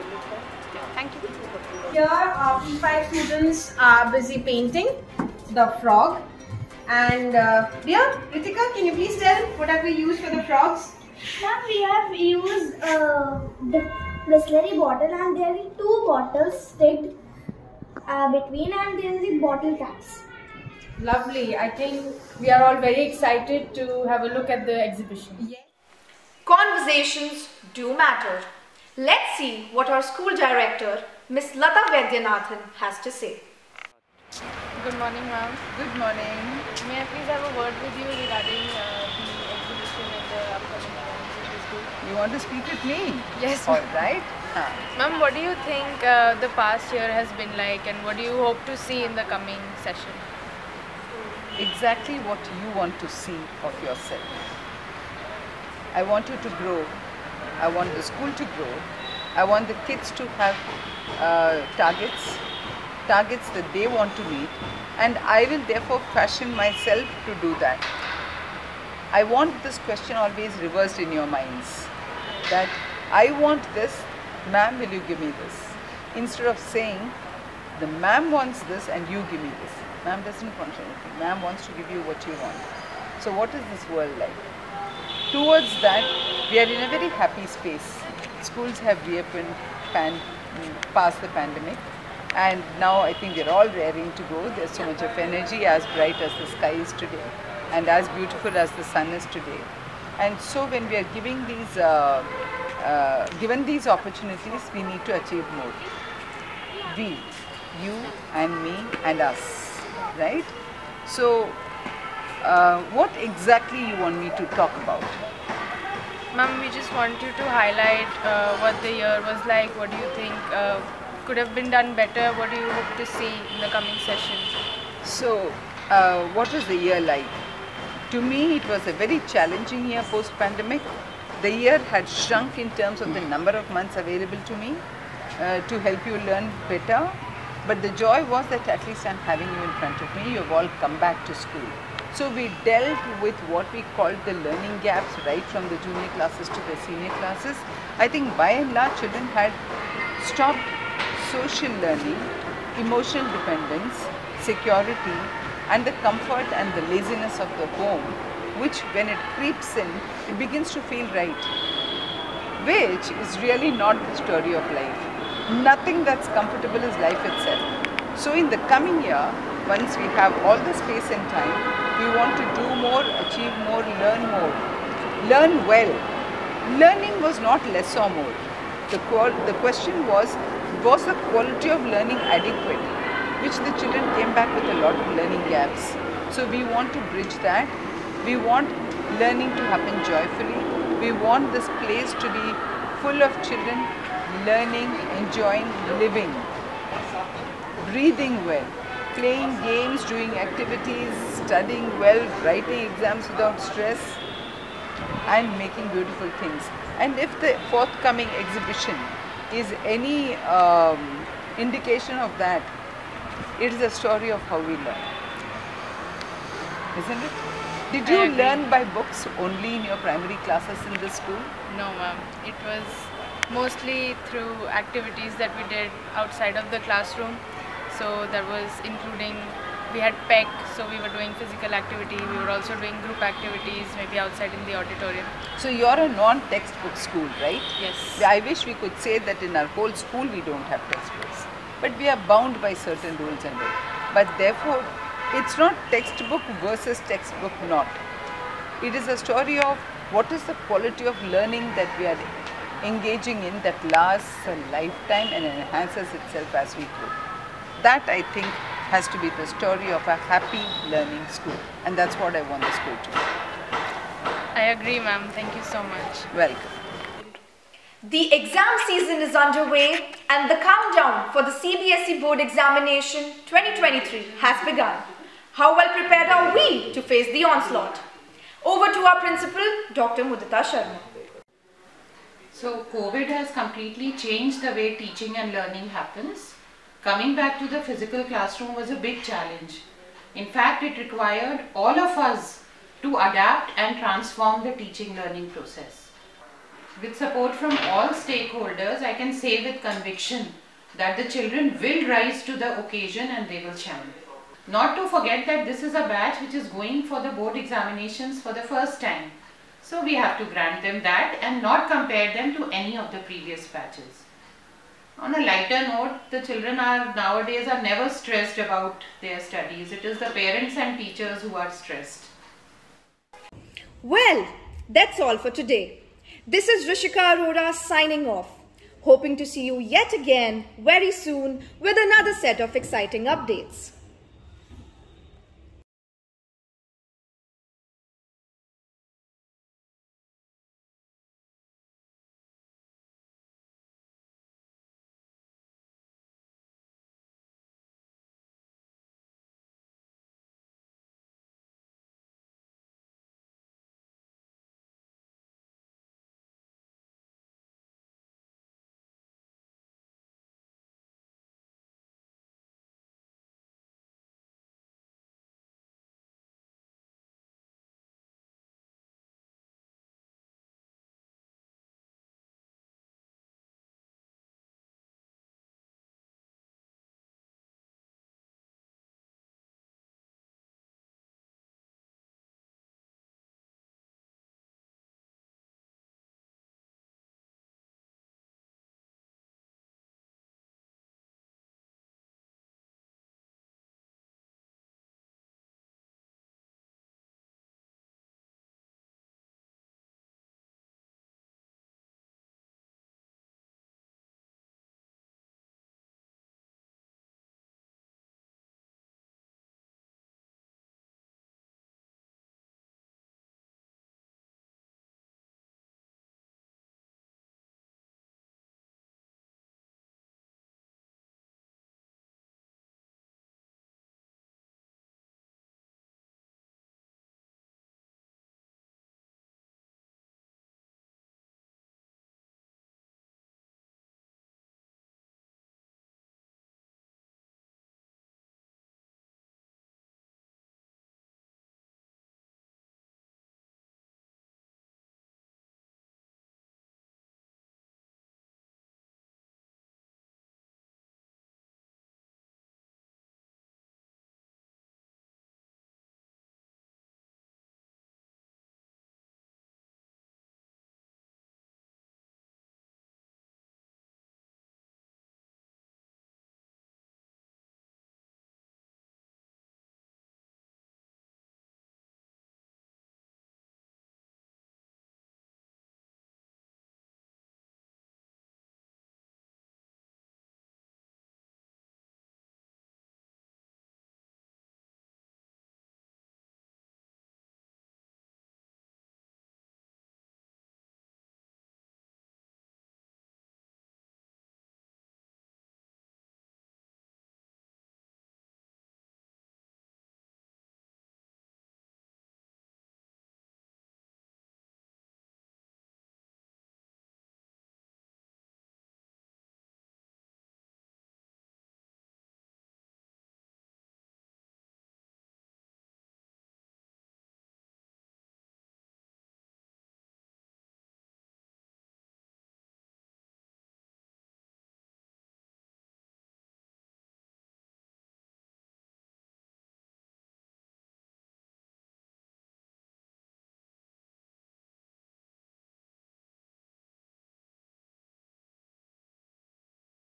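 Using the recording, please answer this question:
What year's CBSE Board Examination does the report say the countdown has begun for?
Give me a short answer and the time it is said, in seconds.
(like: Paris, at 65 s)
2023, at 273 s.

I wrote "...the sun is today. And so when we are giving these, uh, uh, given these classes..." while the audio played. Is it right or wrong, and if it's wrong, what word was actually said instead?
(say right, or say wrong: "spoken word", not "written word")
wrong: "opportunities", not "classes".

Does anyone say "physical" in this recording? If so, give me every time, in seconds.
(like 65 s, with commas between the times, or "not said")
231 s, 287 s.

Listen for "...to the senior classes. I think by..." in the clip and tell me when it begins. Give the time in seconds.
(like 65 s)
146 s.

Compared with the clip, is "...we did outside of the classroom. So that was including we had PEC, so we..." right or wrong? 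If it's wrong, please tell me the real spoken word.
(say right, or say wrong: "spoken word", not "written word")
right.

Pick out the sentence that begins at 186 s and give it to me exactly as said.
So we want to bridge that.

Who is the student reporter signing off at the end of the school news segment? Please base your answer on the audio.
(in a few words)
Rishika Arora.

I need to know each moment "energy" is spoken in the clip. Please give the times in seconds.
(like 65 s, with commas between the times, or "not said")
95 s.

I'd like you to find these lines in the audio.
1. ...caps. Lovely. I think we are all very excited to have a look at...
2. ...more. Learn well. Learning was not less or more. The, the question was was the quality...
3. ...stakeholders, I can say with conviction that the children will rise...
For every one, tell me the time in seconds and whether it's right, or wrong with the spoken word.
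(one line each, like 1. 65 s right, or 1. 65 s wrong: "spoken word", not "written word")
1. 19 s right
2. 174 s right
3. 298 s right.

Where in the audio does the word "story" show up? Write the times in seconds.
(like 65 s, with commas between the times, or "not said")
164 s, 213 s, 249 s, 259 s.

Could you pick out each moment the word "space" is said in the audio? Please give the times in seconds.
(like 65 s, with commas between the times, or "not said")
87 s, 170 s.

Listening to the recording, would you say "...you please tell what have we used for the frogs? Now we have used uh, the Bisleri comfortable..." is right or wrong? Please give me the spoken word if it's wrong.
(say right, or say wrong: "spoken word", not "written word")
wrong: "bottle", not "comfortable".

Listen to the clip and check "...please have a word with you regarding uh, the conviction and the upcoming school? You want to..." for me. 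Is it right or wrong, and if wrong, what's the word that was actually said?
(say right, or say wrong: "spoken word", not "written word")
wrong: "exhibition", not "conviction".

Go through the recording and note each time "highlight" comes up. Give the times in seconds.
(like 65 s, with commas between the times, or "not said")
117 s.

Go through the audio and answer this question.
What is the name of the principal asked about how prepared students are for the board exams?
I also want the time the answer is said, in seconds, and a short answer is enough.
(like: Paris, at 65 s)
Dr. Mudita Sharma, at 279 s.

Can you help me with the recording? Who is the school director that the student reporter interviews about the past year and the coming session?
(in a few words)
Lata Vaidyanathan.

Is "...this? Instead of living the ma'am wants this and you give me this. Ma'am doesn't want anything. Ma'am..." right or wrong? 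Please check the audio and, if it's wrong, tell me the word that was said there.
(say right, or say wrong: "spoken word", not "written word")
wrong: "saying", not "living".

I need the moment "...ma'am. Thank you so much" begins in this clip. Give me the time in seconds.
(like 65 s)
264 s.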